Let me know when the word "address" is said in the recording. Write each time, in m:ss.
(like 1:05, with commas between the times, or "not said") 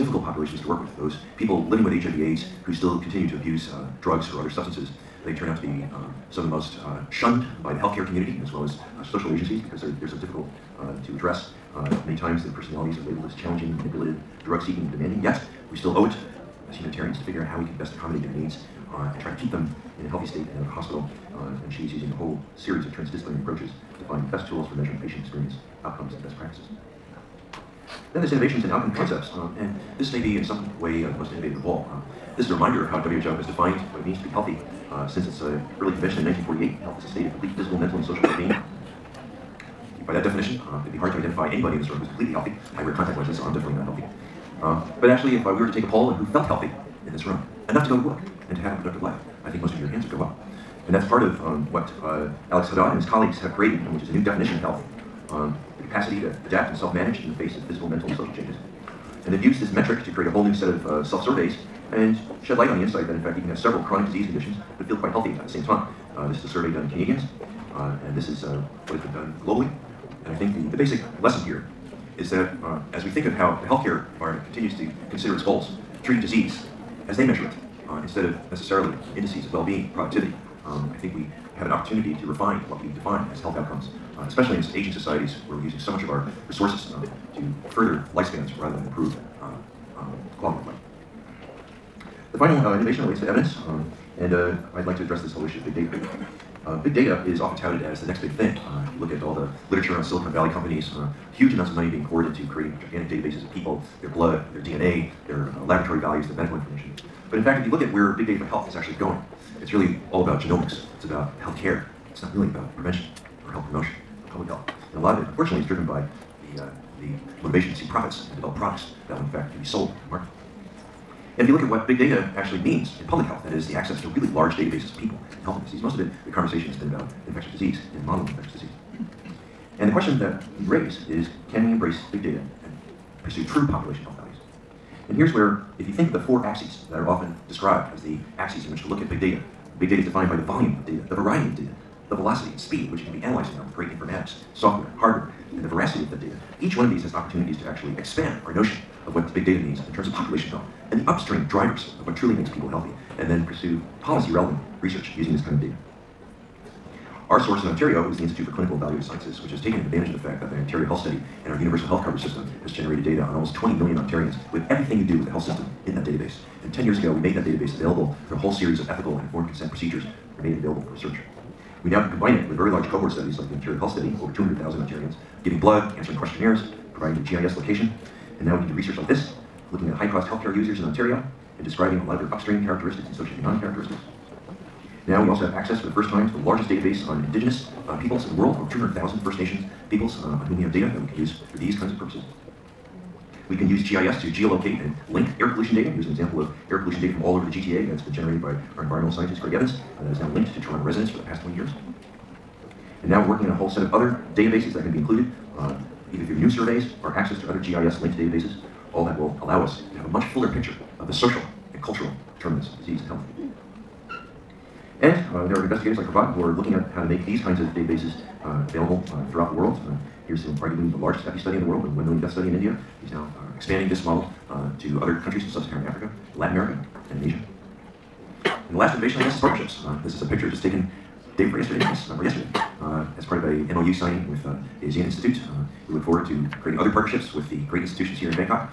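0:11, 1:35.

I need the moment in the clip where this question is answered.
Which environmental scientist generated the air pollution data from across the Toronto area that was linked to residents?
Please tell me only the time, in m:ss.
3:19.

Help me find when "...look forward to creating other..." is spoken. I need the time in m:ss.
3:55.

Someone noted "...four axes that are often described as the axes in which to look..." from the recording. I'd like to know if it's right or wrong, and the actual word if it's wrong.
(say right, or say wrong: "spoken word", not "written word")
right.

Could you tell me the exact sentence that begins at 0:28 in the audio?
Then there's innovations in outcome concepts, um, and this may be in some way uh, the most innovative of all.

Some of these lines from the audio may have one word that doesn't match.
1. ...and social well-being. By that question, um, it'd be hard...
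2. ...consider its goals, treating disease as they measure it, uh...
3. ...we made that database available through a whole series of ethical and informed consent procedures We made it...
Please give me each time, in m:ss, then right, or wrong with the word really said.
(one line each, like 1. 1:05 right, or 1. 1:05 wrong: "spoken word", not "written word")
1. 0:37 wrong: "definition", not "question"
2. 1:15 right
3. 2:47 right.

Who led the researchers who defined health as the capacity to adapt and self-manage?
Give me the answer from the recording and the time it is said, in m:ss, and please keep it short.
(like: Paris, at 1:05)
Alex Jadad, at 0:52.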